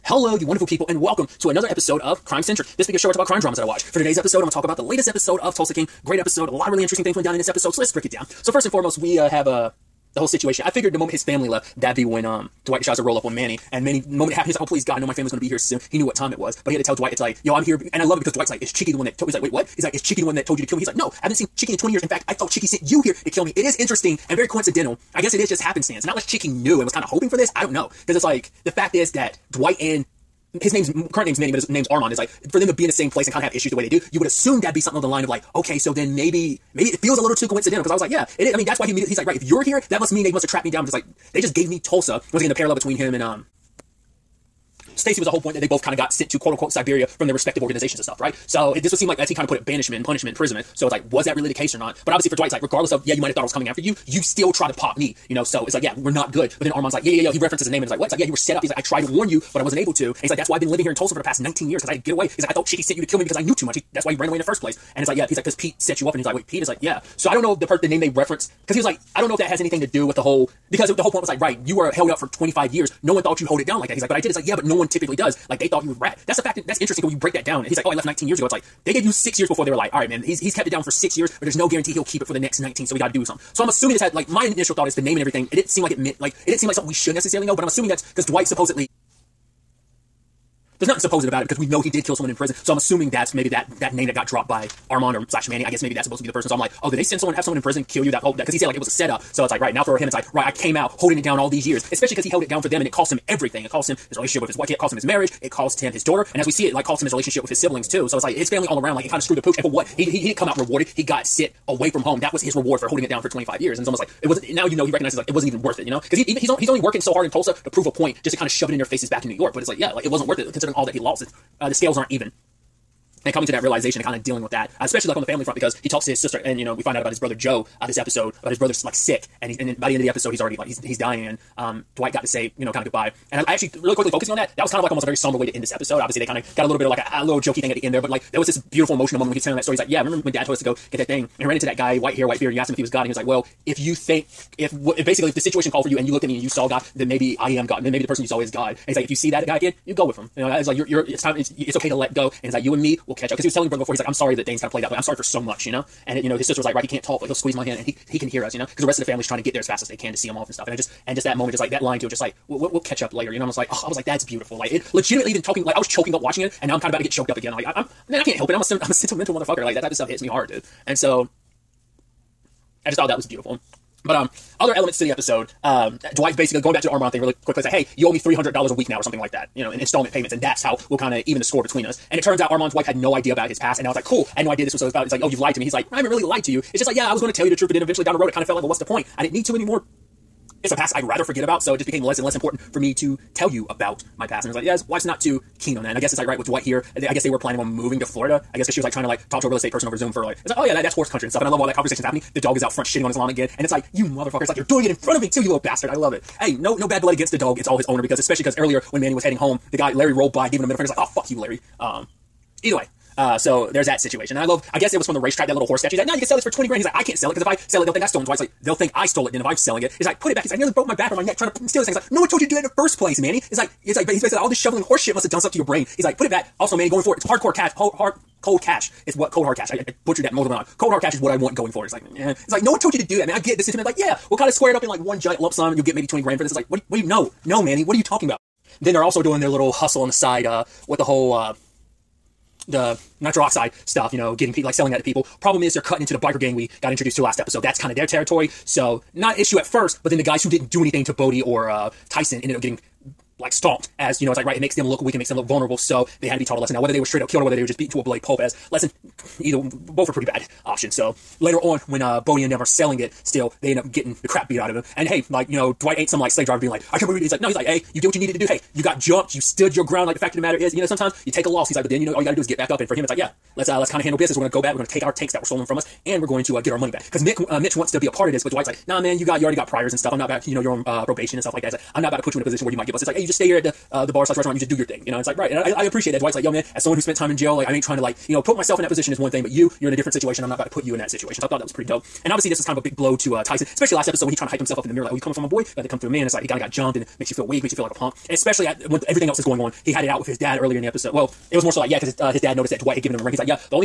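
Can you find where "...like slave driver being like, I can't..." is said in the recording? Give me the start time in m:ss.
4:26.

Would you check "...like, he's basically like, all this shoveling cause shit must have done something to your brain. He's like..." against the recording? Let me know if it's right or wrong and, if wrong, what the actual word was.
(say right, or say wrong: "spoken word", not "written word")
wrong: "horse", not "cause".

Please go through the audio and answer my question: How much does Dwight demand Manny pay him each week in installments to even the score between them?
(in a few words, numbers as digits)
$300.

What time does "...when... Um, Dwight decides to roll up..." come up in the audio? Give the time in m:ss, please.
0:12.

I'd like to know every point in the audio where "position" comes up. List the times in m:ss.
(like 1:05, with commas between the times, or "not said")
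4:42, 4:48.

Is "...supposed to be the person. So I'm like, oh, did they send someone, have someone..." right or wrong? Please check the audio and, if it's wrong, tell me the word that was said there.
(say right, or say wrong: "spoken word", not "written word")
right.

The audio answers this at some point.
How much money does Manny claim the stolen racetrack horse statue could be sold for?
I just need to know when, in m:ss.
3:36.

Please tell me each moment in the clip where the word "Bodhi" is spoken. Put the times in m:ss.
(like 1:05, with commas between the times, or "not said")
4:11, 4:22.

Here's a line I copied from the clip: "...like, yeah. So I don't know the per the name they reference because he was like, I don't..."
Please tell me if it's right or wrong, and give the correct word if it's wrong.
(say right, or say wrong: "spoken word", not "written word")
right.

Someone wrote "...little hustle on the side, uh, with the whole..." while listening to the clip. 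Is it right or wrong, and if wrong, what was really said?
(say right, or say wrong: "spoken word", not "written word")
right.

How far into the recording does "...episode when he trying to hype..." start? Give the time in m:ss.
4:54.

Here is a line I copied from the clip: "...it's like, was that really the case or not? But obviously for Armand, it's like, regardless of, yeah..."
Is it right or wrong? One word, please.
wrong.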